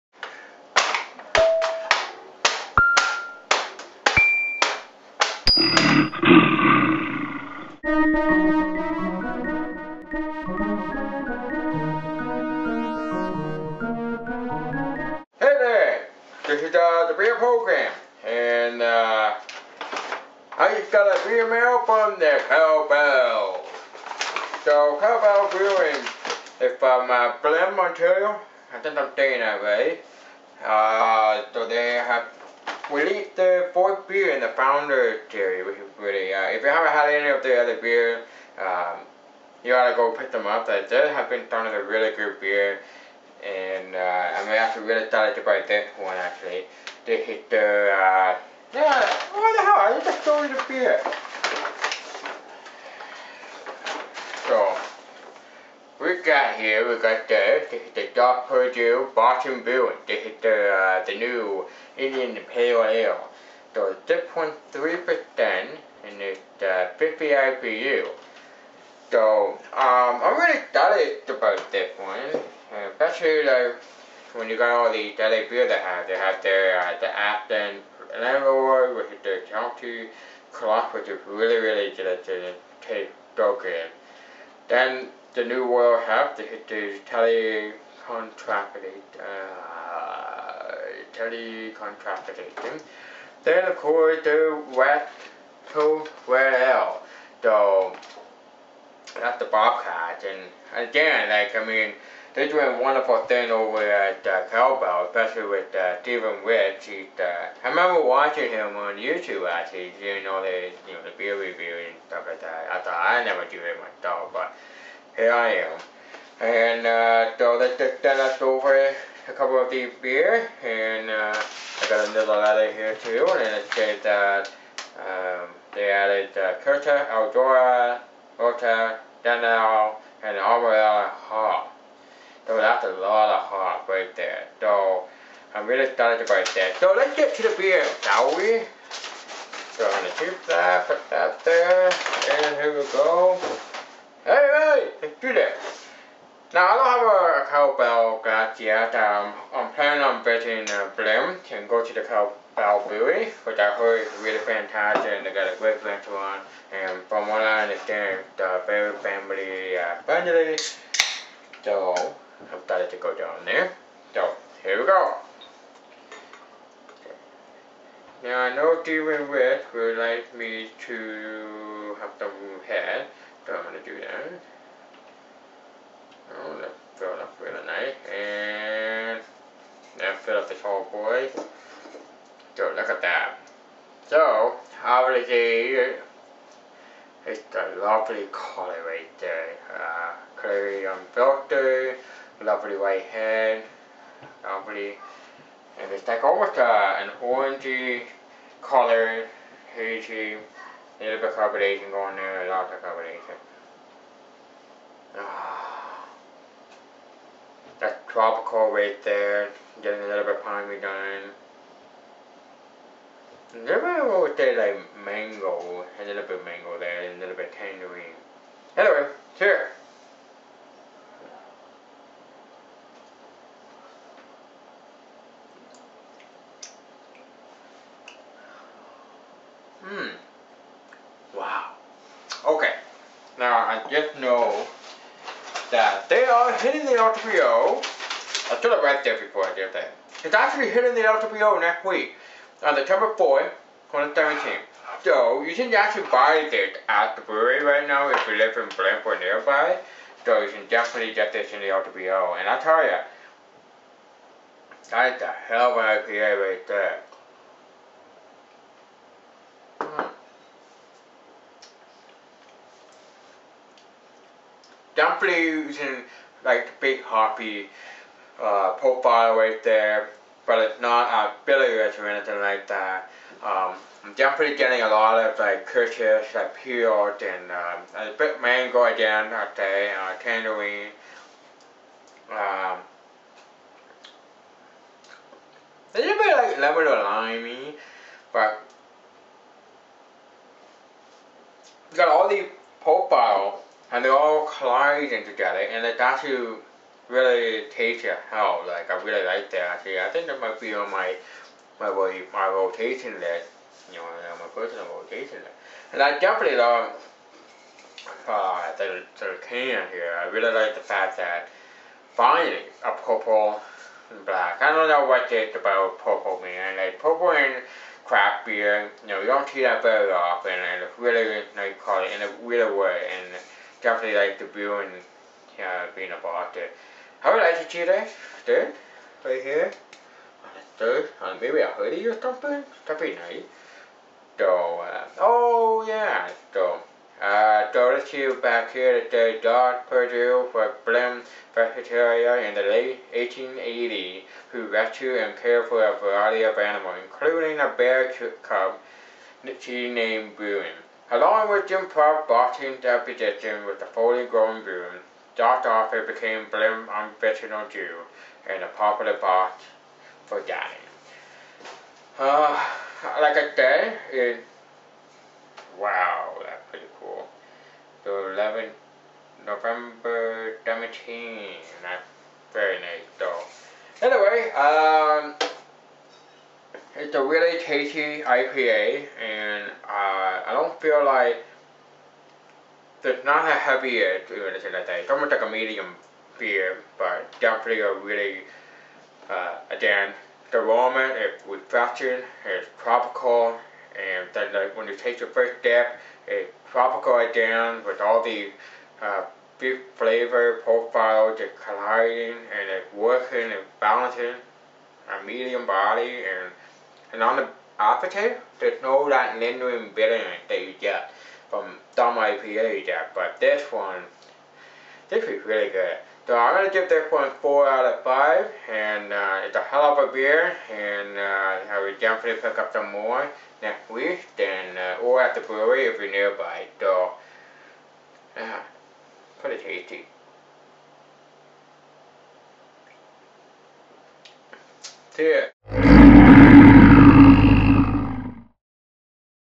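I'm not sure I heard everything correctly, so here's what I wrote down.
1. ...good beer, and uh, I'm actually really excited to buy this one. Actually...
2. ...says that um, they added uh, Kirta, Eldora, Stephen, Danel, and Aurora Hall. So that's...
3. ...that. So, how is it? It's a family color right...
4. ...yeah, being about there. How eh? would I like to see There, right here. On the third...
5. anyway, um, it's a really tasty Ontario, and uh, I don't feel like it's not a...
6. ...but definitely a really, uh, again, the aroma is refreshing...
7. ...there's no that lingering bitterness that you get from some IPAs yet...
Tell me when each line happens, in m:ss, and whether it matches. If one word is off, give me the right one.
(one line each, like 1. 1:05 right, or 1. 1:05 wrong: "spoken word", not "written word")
1. 0:42 right
2. 2:03 wrong: "Ota", not "Stephen"
3. 3:03 wrong: "lovely", not "family"
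4. 5:25 right
5. 6:14 wrong: "IPA", not "Ontario"
6. 6:26 right
7. 6:48 right.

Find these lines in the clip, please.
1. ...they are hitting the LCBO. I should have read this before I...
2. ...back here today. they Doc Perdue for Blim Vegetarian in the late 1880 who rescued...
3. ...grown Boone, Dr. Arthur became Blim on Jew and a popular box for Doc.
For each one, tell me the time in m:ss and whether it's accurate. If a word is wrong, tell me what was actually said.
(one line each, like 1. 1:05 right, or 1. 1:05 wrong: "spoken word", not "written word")
1. 3:56 right
2. 5:38 right
3. 5:54 wrong: "Danny", not "Doc".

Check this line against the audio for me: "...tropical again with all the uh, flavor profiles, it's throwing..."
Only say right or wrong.
wrong.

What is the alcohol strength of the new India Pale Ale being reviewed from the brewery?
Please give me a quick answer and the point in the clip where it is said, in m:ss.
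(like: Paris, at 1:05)
6.3%, at 1:04.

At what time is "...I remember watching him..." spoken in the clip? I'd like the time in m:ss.
1:47.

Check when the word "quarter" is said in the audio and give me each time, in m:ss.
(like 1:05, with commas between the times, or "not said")
not said.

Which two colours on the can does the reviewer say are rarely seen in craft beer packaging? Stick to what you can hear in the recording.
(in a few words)
Purple and black.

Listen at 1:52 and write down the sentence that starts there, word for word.
I thought I never do it myself, but here I am.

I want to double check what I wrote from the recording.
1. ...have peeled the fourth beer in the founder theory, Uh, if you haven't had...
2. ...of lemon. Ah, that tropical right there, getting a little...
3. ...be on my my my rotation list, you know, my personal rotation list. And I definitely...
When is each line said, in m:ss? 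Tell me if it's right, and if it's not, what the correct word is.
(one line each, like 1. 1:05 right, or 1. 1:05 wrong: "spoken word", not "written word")
1. 0:32 wrong: "released", not "peeled"
2. 3:22 wrong: "carbonation", not "lemon"
3. 5:00 right.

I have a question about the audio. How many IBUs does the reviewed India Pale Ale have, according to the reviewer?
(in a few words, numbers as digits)
50.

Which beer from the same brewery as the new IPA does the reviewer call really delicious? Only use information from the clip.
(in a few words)
Absent Landlord.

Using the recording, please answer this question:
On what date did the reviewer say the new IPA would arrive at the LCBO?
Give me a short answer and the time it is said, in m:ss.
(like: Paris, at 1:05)
September 4th, 2017, at 4:02.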